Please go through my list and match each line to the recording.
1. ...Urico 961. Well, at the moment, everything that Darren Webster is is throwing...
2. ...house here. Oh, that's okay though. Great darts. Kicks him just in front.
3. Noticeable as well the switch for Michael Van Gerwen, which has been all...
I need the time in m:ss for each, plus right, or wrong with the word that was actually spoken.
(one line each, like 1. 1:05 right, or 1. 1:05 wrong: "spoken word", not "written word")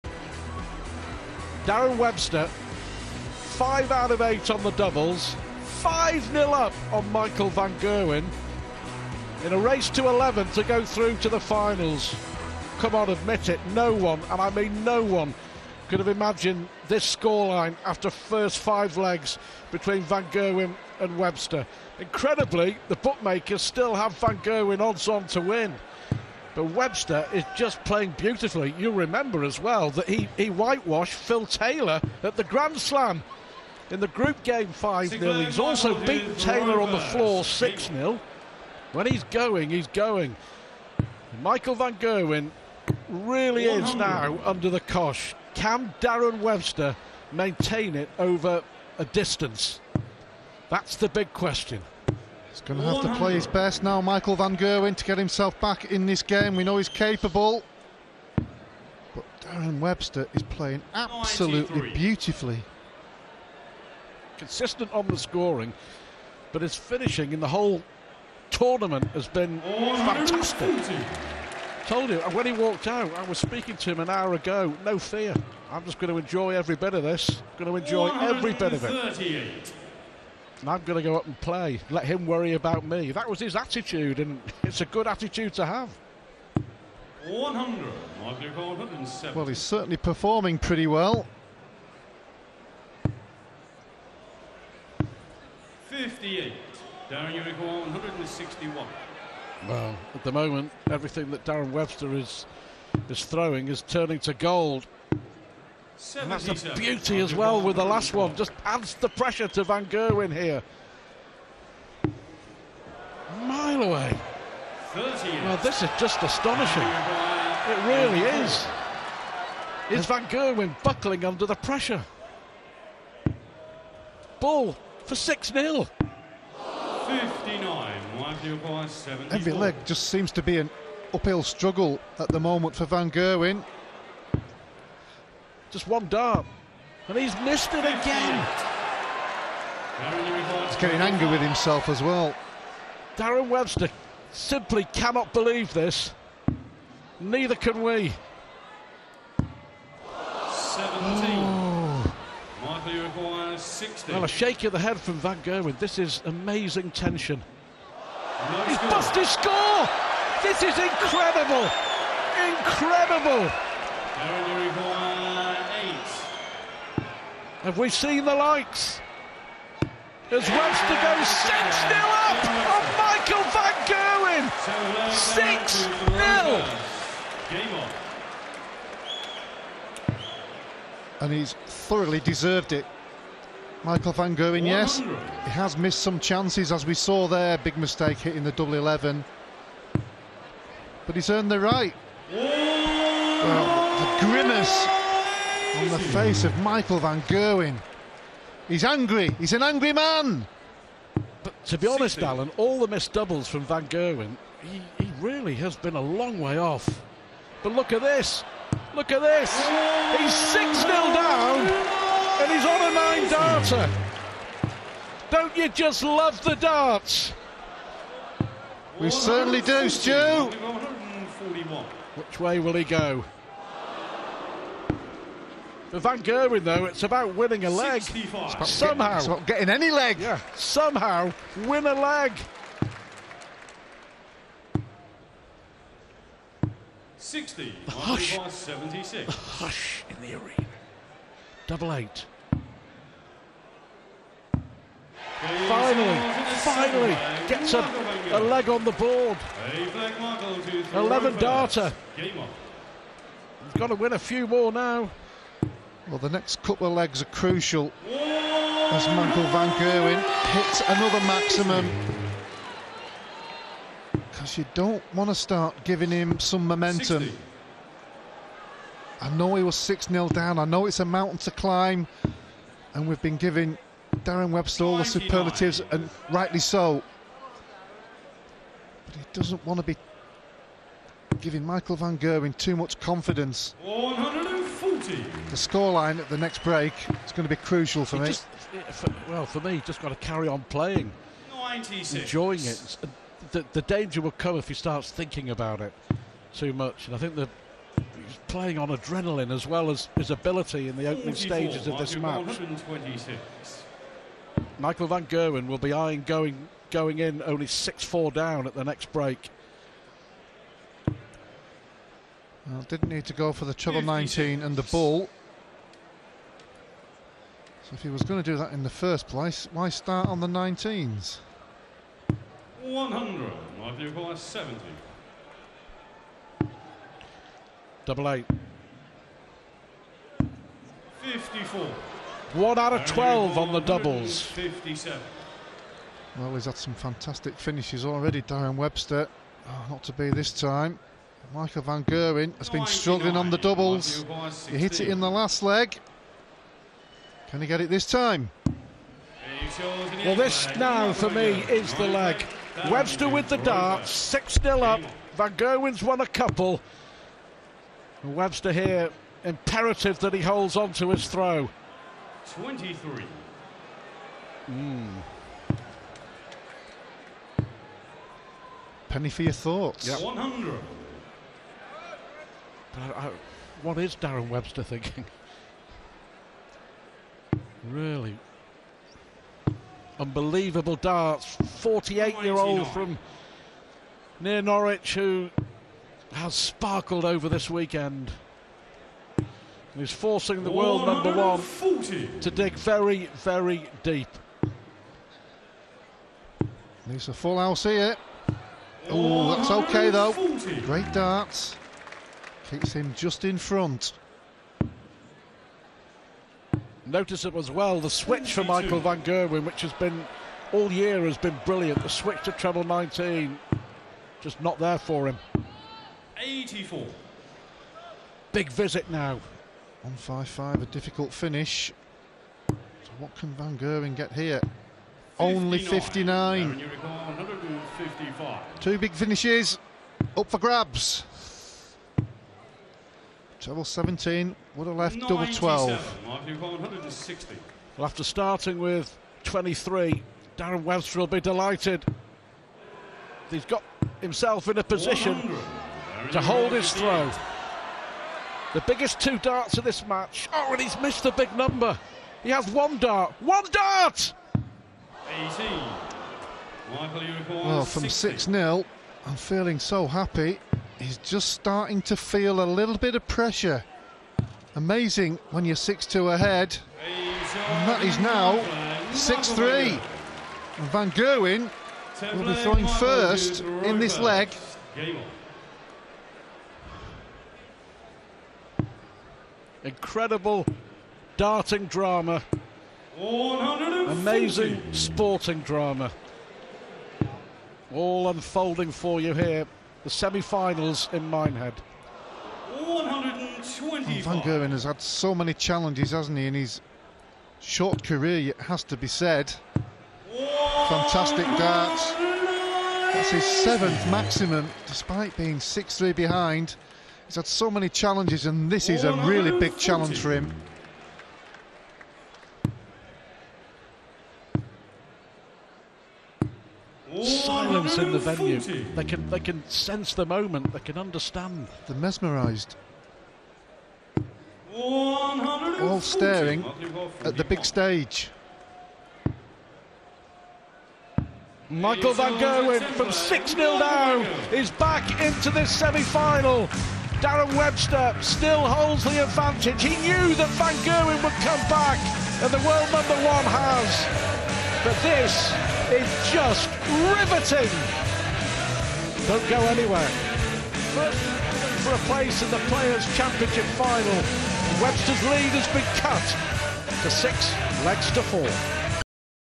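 1. 1:37 wrong: "161", not "961"
2. 6:37 right
3. 6:47 right.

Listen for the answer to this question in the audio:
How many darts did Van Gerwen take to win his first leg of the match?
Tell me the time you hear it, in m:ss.
4:10.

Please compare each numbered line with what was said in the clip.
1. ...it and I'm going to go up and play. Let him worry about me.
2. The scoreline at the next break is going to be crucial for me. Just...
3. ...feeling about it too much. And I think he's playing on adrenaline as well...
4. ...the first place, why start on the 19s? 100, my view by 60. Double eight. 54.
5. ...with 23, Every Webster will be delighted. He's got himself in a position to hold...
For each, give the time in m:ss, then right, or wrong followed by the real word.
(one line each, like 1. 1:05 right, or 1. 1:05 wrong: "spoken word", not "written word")
1. 1:18 right
2. 4:45 right
3. 4:55 wrong: "thinking", not "feeling"
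4. 5:18 wrong: "70", not "60"
5. 7:18 wrong: "Darren", not "Every".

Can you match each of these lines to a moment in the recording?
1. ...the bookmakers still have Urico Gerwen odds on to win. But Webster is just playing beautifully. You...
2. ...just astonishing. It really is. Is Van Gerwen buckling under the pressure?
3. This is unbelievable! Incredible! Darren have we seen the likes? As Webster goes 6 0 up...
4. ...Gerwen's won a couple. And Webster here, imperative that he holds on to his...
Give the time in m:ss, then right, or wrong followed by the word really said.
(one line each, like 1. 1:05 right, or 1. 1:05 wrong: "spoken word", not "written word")
1. 0:22 wrong: "Van", not "Urico"
2. 1:55 right
3. 2:40 wrong: "incredible", not "unbelievable"
4. 5:55 right.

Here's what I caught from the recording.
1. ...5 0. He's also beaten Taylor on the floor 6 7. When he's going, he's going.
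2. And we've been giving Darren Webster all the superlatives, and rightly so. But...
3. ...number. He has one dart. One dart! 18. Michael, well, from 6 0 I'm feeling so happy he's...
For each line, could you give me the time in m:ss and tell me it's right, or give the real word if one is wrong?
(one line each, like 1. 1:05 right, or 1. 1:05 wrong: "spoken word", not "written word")
1. 0:34 wrong: "0", not "7"
2. 4:32 right
3. 7:31 right.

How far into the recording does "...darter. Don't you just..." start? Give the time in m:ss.
3:33.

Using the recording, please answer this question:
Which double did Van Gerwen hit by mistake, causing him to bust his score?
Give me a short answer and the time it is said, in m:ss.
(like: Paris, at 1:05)
Double 11, at 3:08.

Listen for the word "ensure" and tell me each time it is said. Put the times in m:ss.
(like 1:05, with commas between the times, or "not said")
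not said.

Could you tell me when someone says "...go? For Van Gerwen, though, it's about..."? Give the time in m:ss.
3:42.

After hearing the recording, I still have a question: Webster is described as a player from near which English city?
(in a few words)
Norwich.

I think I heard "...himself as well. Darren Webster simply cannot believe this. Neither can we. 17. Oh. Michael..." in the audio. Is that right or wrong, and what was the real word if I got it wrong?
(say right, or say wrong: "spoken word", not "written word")
right.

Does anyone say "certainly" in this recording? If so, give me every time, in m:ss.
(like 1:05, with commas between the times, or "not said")
1:29, 3:39.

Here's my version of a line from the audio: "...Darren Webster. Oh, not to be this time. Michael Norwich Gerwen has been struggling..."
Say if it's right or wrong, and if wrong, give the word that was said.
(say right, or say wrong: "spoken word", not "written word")
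wrong: "Van", not "Norwich".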